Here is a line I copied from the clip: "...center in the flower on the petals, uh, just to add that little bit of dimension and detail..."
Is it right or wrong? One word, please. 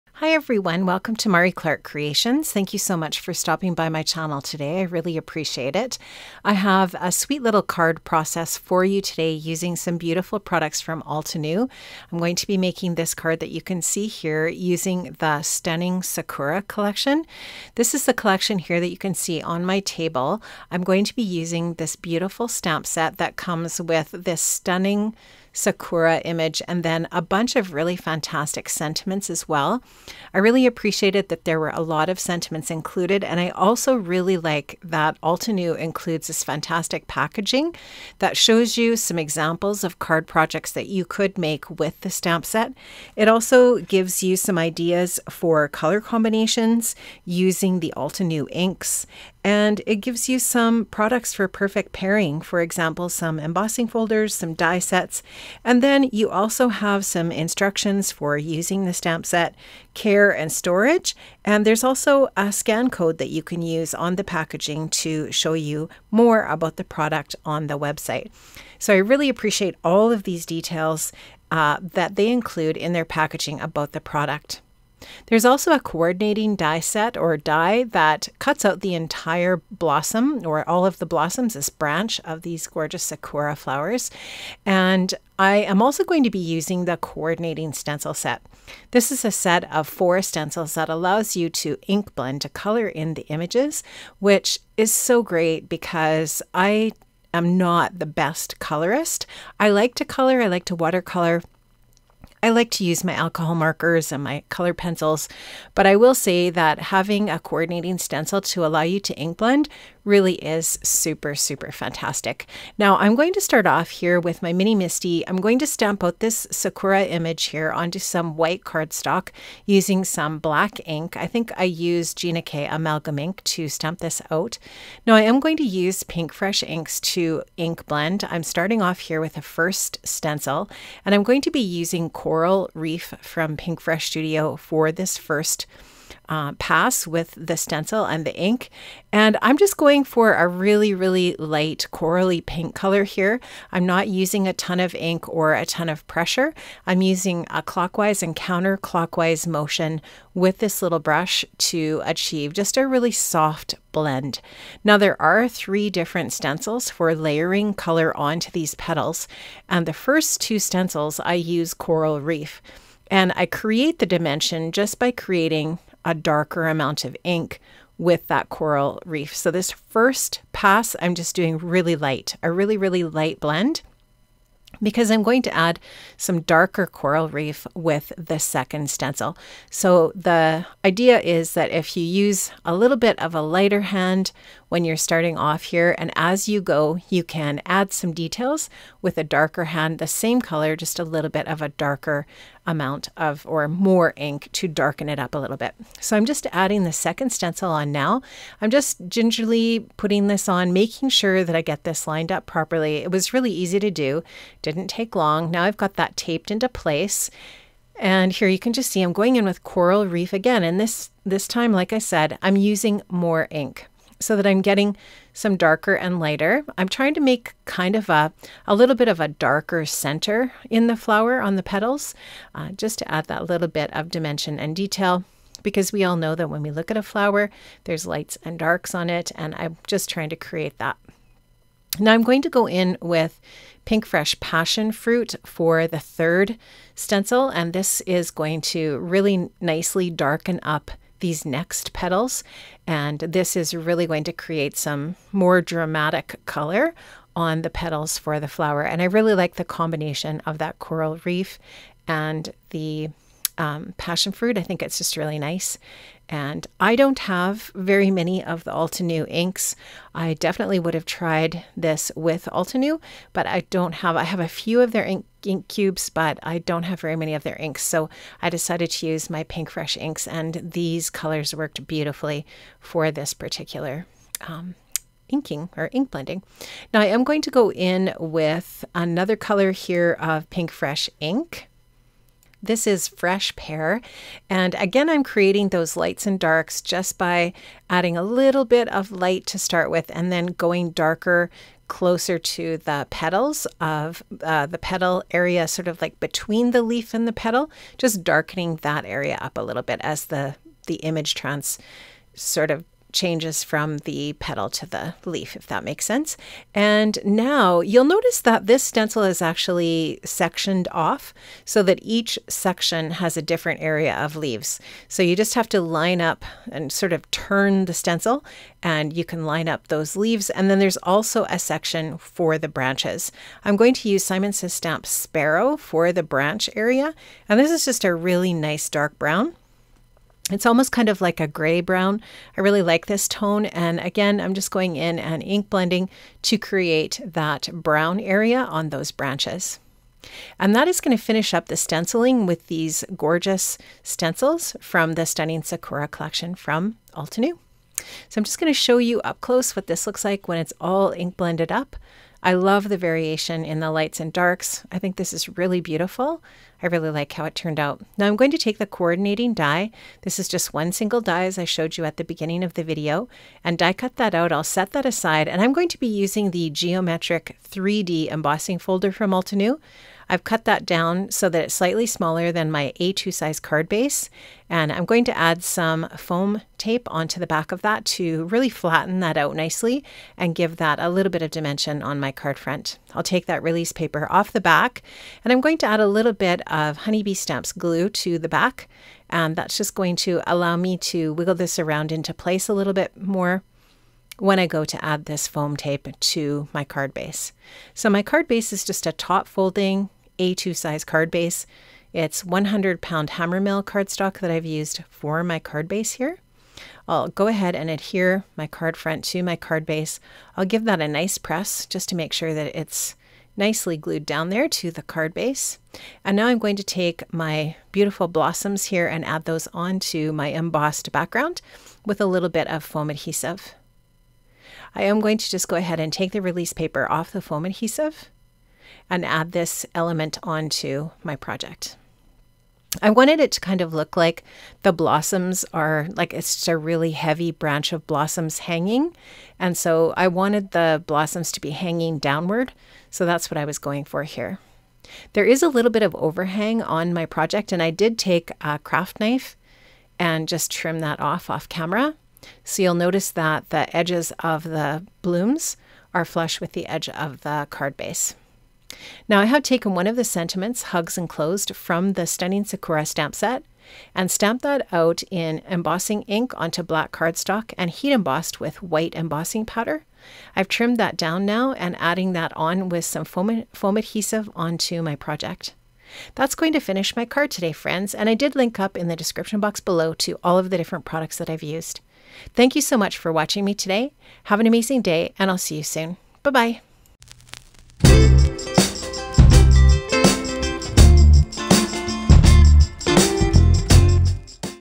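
right.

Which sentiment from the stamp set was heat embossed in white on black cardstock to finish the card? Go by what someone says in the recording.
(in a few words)
Hugs Enclosed.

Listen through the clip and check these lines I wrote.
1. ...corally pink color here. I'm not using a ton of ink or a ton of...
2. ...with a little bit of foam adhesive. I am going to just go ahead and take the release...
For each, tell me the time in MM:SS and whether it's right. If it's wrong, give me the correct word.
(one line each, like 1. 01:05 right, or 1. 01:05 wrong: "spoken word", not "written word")
1. 02:21 right
2. 07:02 right.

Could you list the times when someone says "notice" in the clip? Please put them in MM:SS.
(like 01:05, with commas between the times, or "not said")
05:08, 07:32.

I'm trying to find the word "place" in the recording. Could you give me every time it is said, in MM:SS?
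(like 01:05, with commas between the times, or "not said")
03:26, 06:32.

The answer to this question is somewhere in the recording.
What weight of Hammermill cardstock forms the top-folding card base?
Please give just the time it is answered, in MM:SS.
06:42.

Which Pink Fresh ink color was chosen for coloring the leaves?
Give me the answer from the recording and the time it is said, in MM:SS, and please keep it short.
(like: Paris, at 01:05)
Fresh Pear, at 04:43.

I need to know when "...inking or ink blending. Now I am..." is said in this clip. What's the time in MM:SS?
04:35.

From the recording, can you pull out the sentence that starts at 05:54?
I think this is really beautiful.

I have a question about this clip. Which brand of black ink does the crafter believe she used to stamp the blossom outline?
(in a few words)
Gina K Amalgam.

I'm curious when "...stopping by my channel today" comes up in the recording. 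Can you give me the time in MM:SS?
00:03.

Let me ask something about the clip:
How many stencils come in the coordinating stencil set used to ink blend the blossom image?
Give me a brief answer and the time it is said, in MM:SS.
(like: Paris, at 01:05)
4, at 01:29.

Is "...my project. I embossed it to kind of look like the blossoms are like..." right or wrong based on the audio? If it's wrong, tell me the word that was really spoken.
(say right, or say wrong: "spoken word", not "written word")
wrong: "wanted", not "embossed".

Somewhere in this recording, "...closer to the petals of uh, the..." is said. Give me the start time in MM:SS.
04:51.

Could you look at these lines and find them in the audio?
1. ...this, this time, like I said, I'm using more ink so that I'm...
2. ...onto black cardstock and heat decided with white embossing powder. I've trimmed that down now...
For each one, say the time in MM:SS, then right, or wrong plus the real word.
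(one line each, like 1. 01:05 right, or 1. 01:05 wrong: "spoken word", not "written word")
1. 03:30 right
2. 07:46 wrong: "embossed", not "decided".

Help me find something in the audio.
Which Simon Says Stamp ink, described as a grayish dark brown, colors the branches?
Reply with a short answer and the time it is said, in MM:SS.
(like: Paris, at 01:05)
Sparrow, at 05:25.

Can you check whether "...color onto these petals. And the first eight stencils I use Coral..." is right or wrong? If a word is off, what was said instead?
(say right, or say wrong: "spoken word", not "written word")
wrong: "two", not "eight".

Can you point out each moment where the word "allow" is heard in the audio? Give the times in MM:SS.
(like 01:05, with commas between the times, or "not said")
01:30, 01:48, 06:30.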